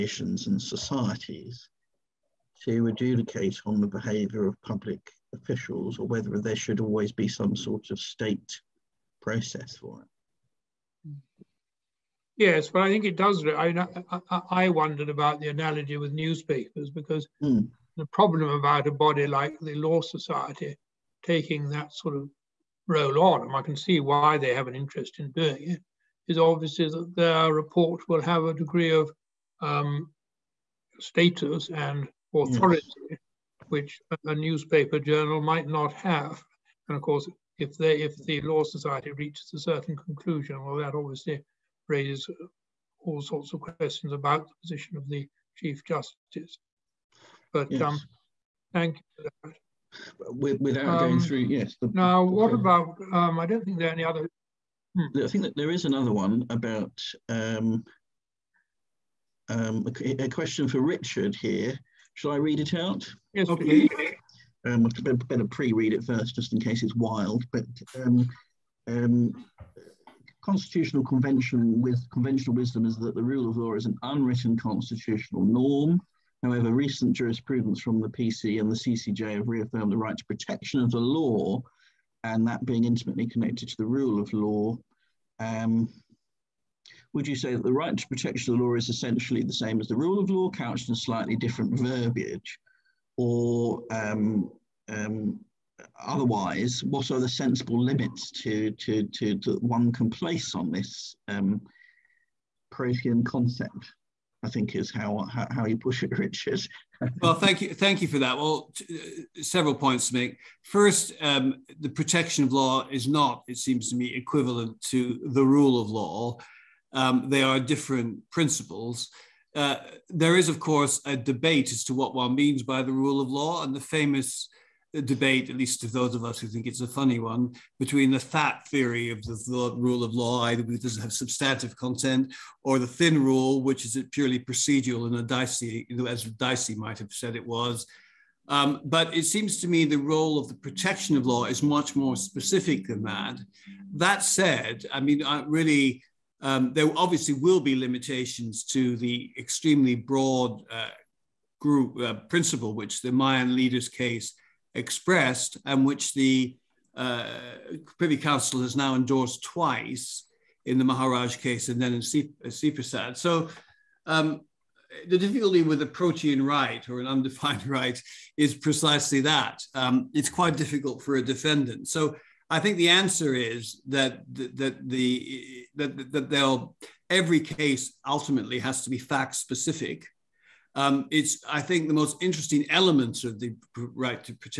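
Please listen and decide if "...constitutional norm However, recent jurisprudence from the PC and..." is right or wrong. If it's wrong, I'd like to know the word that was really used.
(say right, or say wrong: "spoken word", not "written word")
right.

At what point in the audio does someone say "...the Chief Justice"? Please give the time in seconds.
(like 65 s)
45 s.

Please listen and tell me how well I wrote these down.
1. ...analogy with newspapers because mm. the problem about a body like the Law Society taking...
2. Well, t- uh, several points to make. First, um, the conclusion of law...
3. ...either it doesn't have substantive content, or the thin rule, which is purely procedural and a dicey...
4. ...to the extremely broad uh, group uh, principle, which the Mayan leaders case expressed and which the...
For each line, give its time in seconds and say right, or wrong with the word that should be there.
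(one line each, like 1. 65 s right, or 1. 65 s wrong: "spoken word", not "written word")
1. 15 s right
2. 108 s wrong: "protection", not "conclusion"
3. 130 s right
4. 148 s right.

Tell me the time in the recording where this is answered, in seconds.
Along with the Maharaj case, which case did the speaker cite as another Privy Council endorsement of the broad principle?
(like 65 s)
162 s.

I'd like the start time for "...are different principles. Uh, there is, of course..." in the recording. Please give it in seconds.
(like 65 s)
117 s.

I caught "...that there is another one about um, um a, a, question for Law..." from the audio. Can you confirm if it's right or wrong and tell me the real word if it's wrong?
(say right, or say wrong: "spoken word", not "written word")
wrong: "Richard", not "Law".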